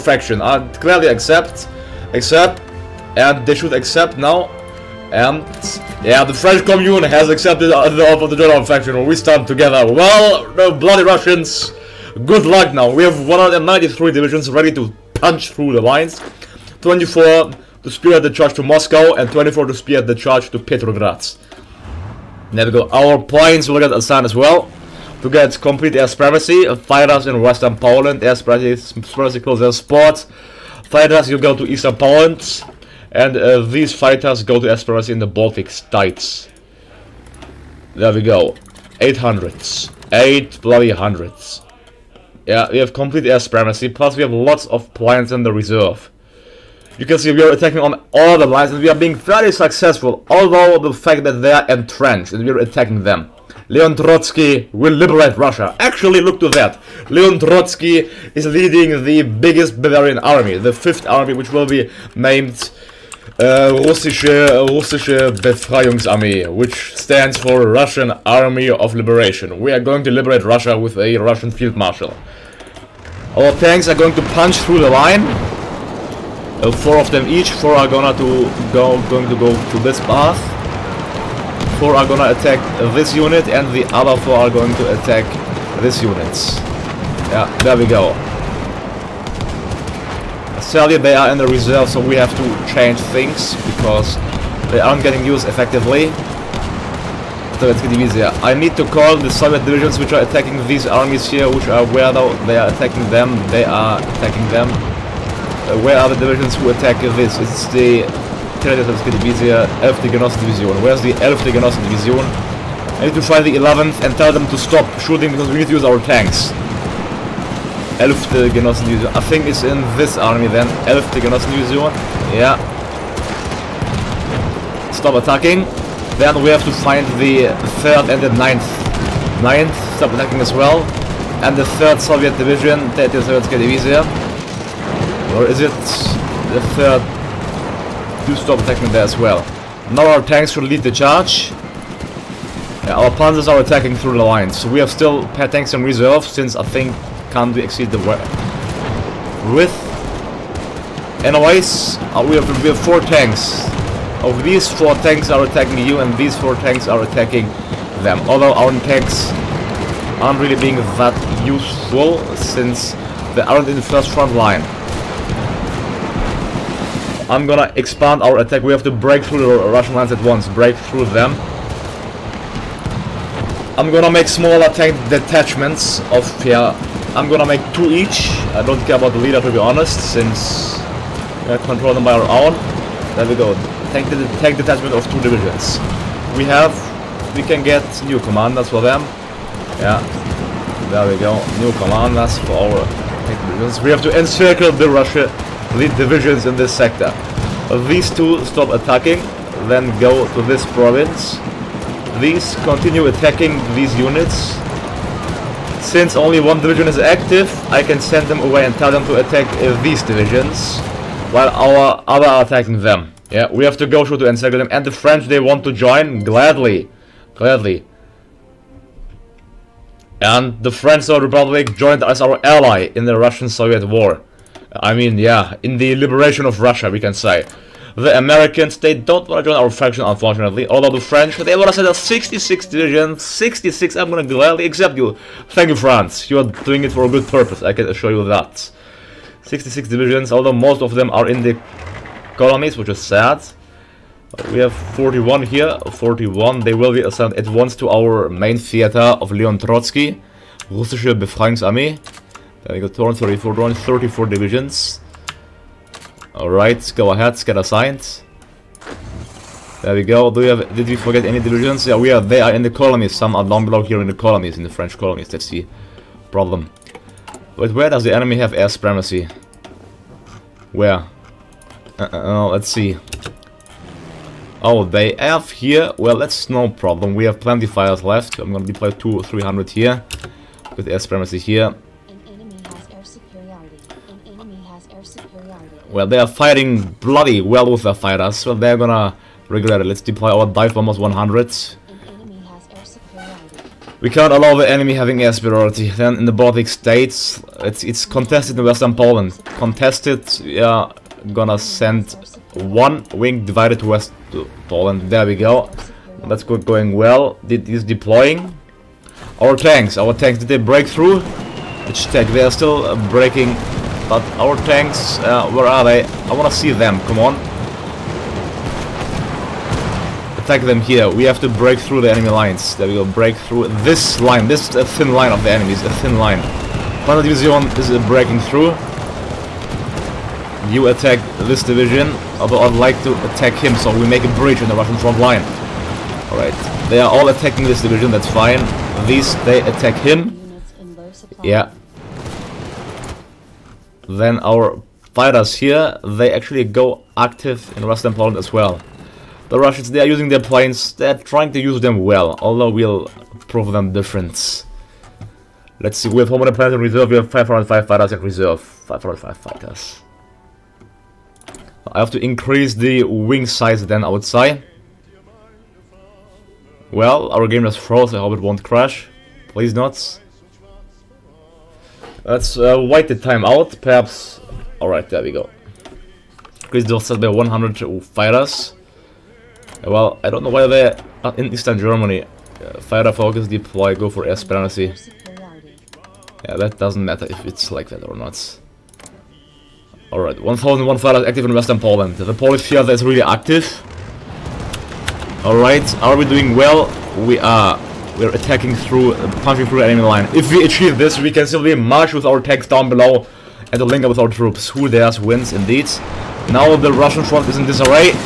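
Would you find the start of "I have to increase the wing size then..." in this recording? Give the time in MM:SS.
06:01.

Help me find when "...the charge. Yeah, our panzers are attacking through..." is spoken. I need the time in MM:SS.
02:20.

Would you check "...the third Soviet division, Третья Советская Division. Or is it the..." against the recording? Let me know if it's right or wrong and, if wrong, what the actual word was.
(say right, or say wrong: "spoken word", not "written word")
right.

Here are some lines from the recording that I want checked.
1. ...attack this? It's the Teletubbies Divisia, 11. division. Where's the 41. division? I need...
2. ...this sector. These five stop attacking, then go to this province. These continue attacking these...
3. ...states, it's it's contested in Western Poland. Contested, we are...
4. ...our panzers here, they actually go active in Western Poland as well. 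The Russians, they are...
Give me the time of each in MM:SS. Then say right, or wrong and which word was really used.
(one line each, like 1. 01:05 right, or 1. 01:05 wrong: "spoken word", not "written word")
1. 01:46 wrong: "11", not "41"
2. 03:16 wrong: "two", not "five"
3. 04:56 right
4. 05:44 wrong: "fighters", not "panzers".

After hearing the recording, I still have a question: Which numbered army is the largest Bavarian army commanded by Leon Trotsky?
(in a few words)
5th.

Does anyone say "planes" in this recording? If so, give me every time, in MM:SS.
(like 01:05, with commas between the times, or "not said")
00:23, 00:44, 05:50, 05:56.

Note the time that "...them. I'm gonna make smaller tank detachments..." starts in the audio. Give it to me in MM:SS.
02:51.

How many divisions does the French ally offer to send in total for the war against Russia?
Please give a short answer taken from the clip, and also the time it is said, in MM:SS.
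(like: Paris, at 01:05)
66, at 03:51.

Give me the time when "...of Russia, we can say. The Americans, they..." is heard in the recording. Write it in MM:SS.
03:46.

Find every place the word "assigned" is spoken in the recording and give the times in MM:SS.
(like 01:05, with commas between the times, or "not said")
00:23, 04:07.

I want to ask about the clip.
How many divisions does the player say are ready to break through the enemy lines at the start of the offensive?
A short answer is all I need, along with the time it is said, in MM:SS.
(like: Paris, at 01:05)
193, at 00:13.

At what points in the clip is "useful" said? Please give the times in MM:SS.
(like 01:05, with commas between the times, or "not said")
02:41.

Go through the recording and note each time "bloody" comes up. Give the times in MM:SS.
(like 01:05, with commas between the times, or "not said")
00:10, 00:40, 04:46.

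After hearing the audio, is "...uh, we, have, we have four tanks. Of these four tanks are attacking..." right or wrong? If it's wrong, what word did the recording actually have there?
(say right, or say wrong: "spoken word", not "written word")
right.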